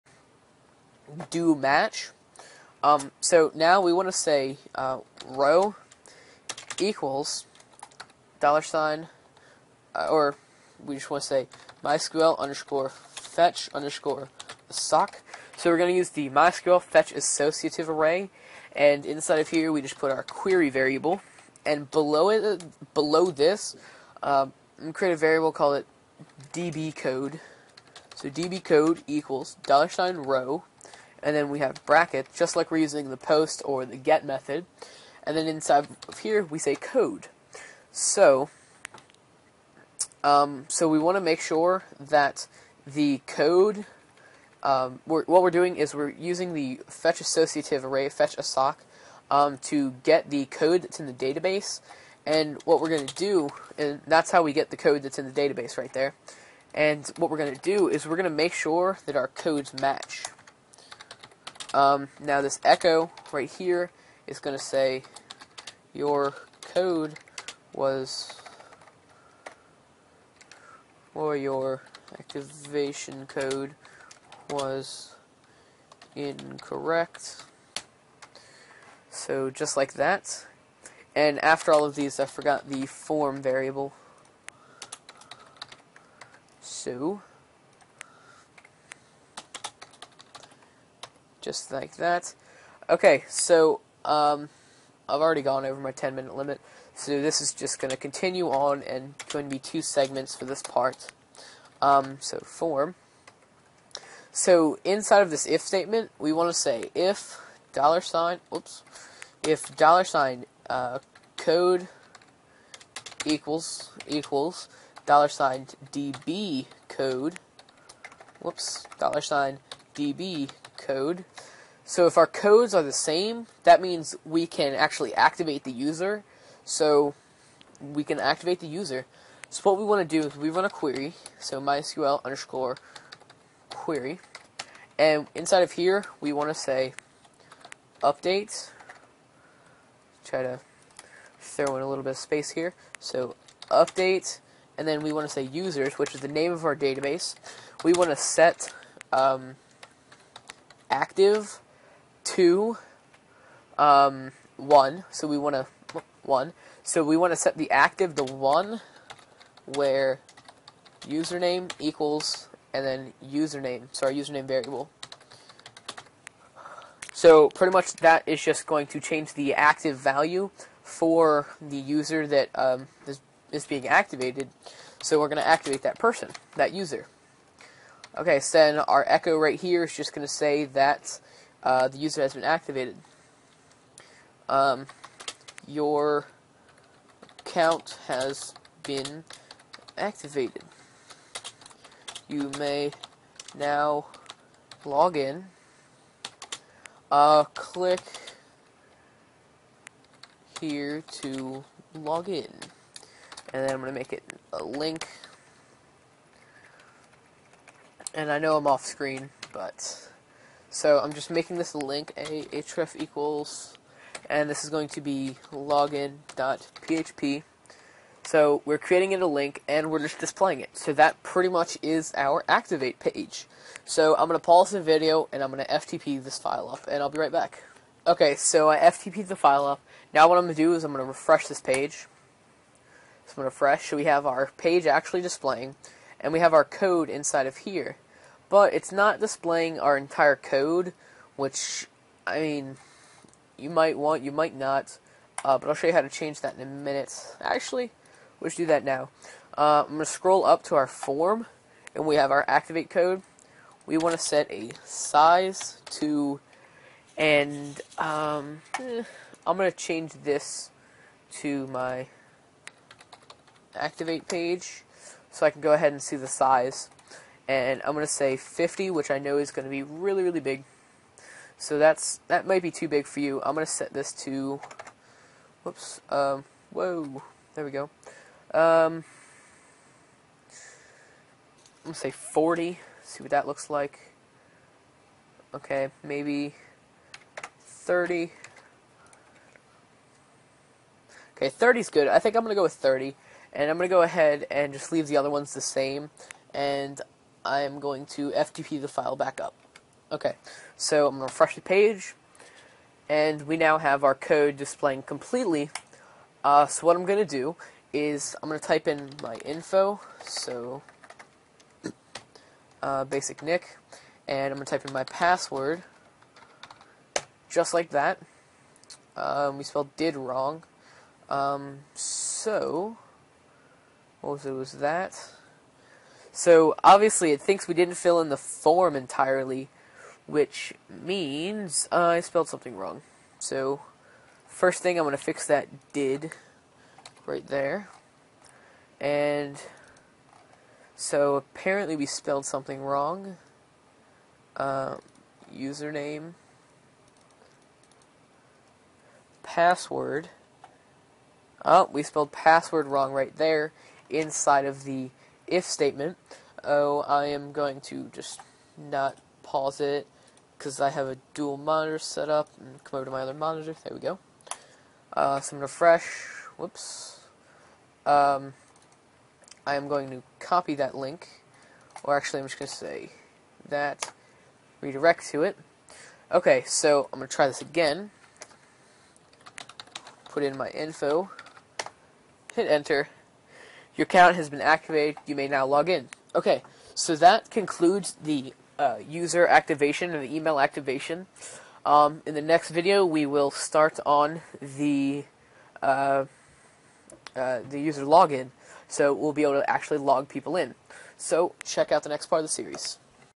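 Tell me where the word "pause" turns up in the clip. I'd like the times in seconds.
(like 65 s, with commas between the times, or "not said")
224 s, 359 s.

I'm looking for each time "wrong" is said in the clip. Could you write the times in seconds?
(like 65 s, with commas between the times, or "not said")
320 s, 332 s, 342 s, 352 s.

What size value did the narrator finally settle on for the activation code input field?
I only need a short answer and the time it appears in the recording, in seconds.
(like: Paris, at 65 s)
30, at 292 s.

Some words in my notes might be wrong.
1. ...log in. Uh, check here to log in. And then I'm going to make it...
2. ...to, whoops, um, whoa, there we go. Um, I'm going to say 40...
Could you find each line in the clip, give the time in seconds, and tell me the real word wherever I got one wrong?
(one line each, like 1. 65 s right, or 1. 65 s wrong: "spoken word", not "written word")
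1. 194 s wrong: "click", not "check"
2. 274 s right.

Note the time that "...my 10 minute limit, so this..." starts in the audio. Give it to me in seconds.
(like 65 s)
95 s.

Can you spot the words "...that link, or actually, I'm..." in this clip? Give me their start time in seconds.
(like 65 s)
370 s.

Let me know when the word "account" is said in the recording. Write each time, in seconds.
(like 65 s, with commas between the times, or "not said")
187 s, 384 s.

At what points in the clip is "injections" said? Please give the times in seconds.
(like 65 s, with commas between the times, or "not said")
not said.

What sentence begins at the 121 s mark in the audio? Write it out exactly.
So if our codes are the same, that means we can actually activate the user.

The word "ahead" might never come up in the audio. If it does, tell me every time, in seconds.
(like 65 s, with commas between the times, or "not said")
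265 s, 294 s.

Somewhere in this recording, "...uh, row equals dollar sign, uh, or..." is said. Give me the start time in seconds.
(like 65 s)
4 s.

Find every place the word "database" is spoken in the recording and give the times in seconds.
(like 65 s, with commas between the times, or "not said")
51 s, 55 s, 146 s.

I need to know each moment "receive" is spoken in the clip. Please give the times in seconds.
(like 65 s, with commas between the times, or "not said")
not said.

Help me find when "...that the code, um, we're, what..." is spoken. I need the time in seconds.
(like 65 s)
41 s.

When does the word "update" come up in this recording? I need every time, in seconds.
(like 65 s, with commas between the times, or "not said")
138 s, 143 s.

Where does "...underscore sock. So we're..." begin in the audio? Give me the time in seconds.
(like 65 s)
13 s.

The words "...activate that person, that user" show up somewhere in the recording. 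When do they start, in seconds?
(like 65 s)
175 s.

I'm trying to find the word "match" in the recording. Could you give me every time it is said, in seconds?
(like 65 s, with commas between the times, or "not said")
1 s, 59 s.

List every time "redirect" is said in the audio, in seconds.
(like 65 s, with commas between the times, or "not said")
374 s.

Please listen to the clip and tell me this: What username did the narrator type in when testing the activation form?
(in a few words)
basixnick.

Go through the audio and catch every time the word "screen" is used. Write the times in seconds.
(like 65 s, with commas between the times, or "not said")
208 s.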